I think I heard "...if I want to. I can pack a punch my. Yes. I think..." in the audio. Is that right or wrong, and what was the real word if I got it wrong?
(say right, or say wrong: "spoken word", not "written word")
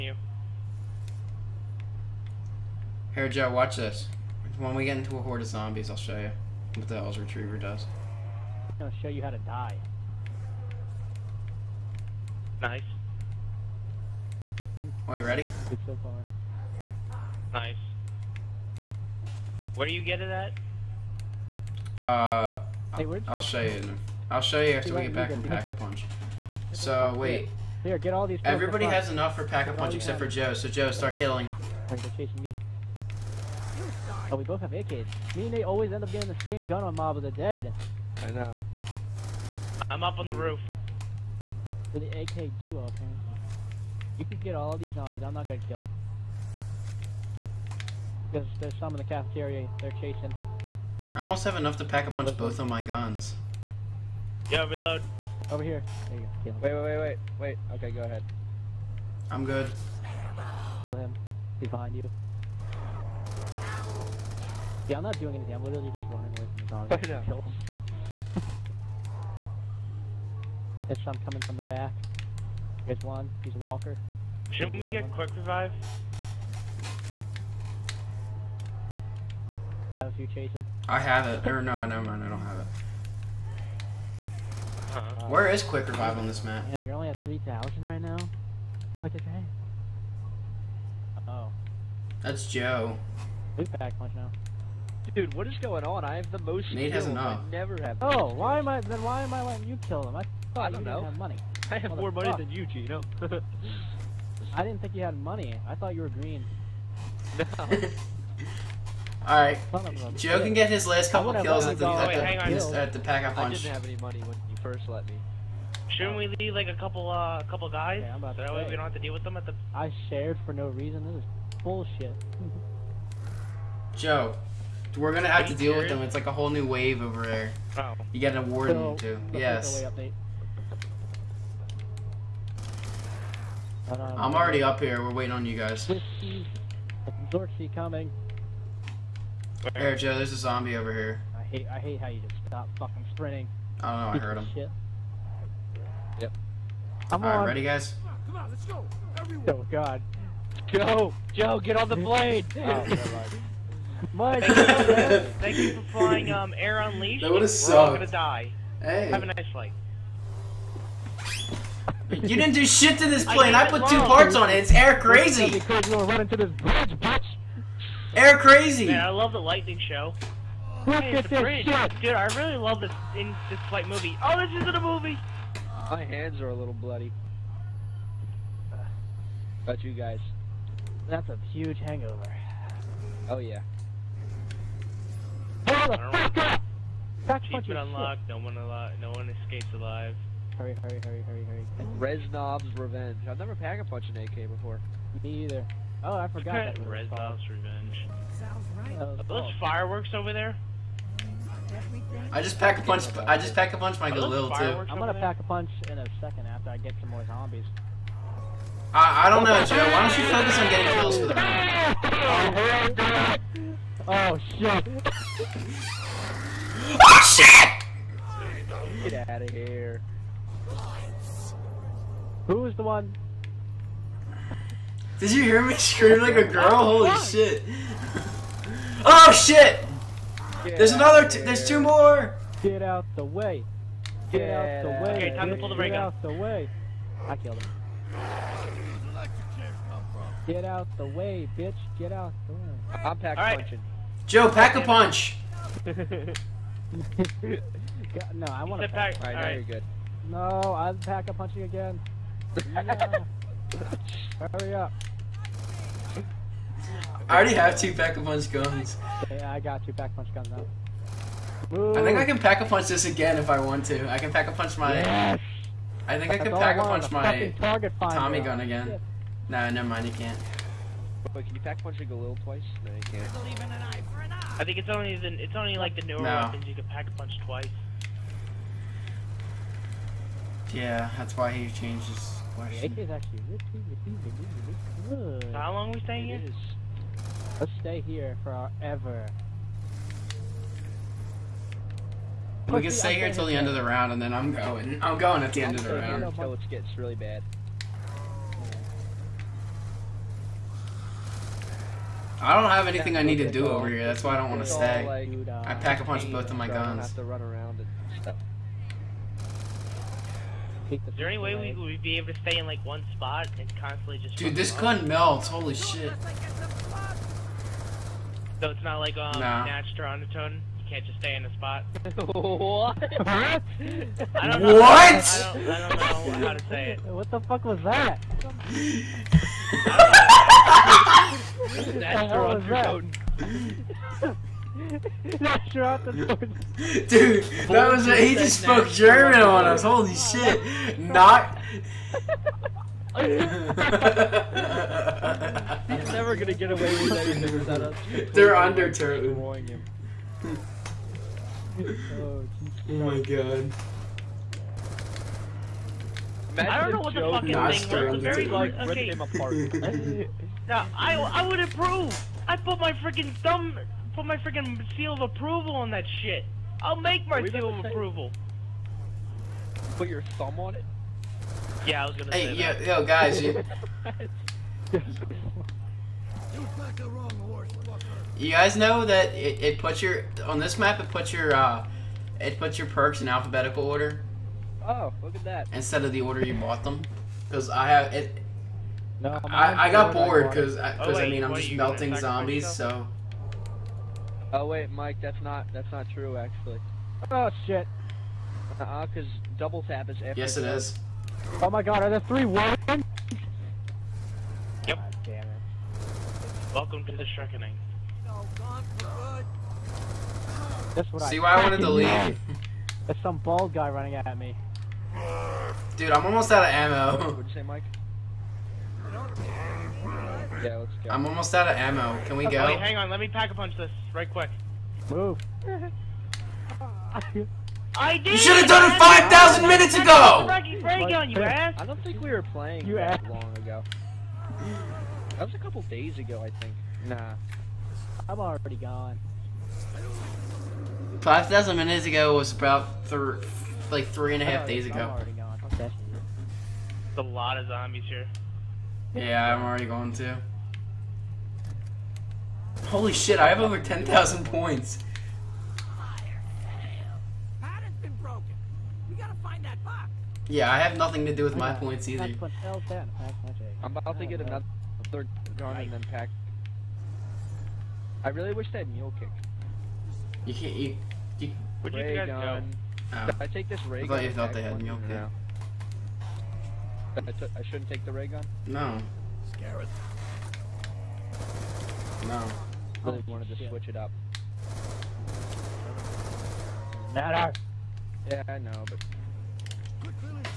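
right.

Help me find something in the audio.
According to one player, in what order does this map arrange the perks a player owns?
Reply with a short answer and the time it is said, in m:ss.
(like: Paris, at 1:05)
Alphabetical order, at 6:23.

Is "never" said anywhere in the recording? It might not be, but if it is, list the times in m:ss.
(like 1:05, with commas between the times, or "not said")
1:21, 1:37, 3:13, 4:29, 5:46.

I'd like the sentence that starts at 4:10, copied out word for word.
No, I'm pack a punching again.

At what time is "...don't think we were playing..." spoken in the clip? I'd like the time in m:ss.
7:11.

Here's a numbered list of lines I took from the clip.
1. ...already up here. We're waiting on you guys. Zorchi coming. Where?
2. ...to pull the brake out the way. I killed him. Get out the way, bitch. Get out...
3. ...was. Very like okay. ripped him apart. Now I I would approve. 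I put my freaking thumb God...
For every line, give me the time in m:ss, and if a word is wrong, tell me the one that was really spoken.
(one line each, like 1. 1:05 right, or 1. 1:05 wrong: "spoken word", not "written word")
1. 2:14 right
2. 3:55 right
3. 5:58 wrong: "Put", not "God".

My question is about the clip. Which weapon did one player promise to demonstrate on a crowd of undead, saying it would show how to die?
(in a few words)
Hell's Retriever.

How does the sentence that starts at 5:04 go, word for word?
That's why I don't want to stay.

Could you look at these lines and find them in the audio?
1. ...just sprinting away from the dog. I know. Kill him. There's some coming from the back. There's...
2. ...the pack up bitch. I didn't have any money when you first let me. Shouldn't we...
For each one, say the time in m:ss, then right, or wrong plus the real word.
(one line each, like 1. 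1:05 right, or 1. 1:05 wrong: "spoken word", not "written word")
1. 1:05 wrong: "running", not "sprinting"
2. 1:52 wrong: "punch", not "bitch".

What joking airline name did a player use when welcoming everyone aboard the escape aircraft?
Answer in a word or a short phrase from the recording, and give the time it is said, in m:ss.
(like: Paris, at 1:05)
Air Unleashed, at 2:36.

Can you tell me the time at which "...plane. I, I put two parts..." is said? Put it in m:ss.
2:43.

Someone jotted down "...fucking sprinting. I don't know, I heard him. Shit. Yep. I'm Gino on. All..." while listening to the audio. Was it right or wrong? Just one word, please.
wrong.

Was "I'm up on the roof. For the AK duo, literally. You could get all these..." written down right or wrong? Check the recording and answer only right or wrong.
wrong.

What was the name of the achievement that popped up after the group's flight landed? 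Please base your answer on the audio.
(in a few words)
No one escapes alive.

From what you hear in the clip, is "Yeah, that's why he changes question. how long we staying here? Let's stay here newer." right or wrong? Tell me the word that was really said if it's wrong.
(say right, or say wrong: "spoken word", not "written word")
wrong: "forever", not "newer".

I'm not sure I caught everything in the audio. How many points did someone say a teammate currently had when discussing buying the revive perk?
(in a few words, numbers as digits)
3,000.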